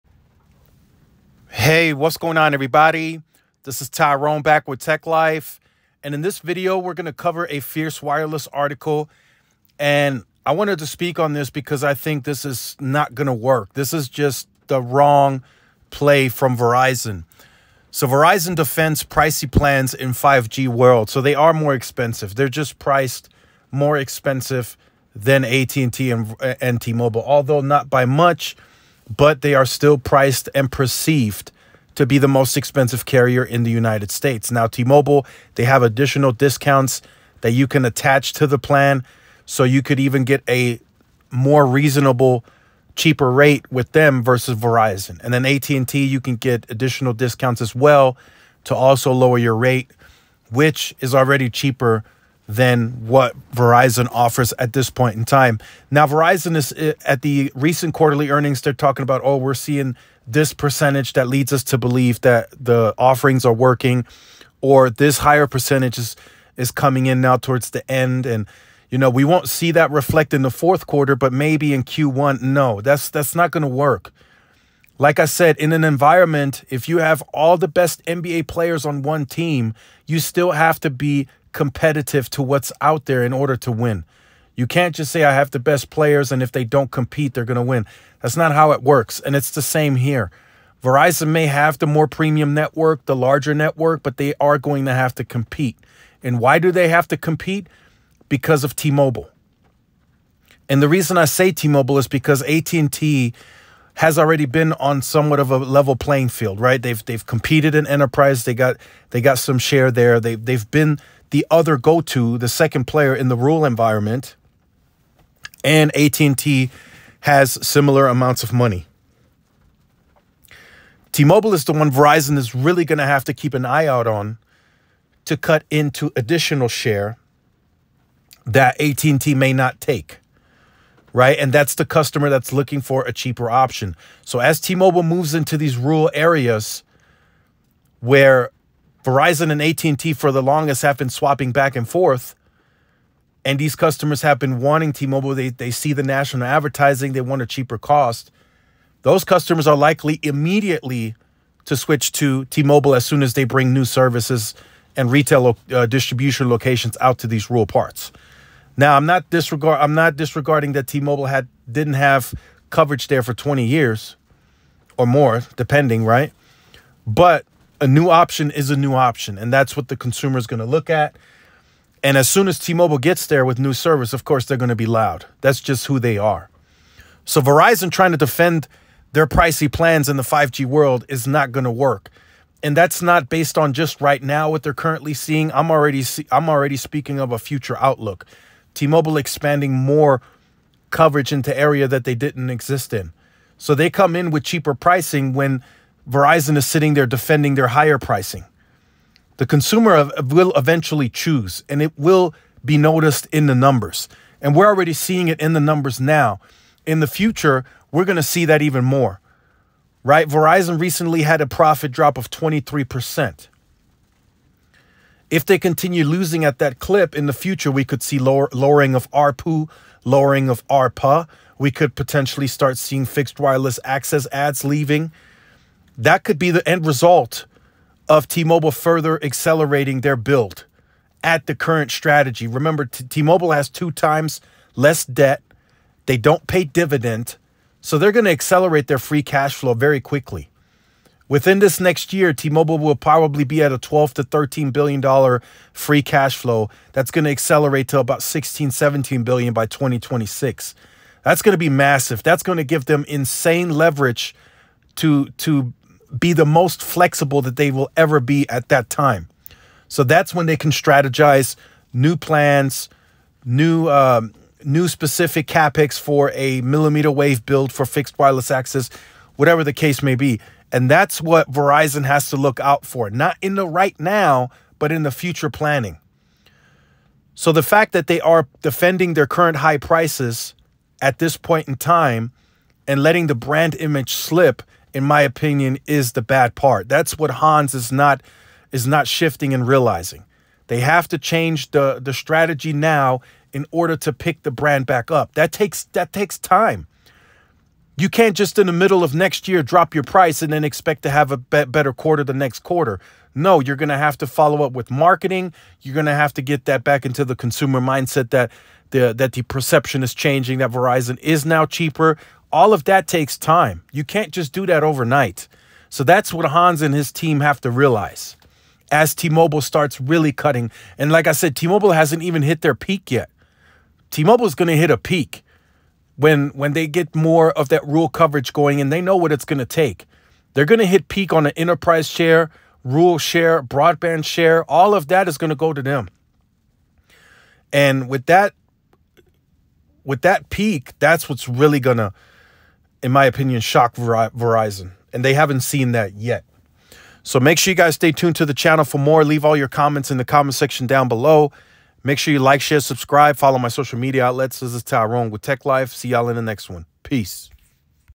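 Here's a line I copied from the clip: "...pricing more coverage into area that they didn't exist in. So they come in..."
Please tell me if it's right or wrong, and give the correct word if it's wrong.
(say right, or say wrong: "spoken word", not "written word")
wrong: "expanding", not "pricing".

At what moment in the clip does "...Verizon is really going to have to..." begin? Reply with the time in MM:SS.
02:01.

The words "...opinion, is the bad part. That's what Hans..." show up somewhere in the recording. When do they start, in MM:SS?
04:45.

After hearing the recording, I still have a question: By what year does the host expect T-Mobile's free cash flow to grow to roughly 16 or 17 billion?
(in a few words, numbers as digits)
2026.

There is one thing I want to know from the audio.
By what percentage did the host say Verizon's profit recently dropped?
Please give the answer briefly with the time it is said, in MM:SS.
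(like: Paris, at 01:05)
23%, at 03:32.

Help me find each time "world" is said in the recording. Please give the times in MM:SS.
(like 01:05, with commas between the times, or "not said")
00:20, 03:00.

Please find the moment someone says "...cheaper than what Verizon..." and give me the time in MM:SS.
00:51.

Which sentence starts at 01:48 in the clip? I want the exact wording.
They got they got some share there.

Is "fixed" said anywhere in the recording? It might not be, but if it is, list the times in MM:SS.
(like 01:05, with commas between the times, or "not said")
03:43, 04:27.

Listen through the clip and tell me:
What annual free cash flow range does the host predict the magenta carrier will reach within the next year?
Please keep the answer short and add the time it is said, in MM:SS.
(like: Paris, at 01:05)
12 to 13 billion dollars, at 04:03.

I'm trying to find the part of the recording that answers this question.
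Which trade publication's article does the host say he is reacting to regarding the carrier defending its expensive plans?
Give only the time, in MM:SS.
00:07.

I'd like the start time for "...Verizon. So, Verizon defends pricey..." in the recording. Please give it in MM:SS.
00:16.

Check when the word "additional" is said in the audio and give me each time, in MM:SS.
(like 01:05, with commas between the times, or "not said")
00:35, 00:46, 02:06.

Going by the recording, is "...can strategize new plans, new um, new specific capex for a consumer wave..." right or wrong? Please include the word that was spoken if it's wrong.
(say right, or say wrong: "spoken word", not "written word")
wrong: "millimeter", not "consumer".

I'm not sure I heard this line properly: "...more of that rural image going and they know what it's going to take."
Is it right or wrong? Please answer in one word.
wrong.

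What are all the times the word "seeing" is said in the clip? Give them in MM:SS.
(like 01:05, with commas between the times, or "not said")
00:59, 03:05, 03:24, 03:42.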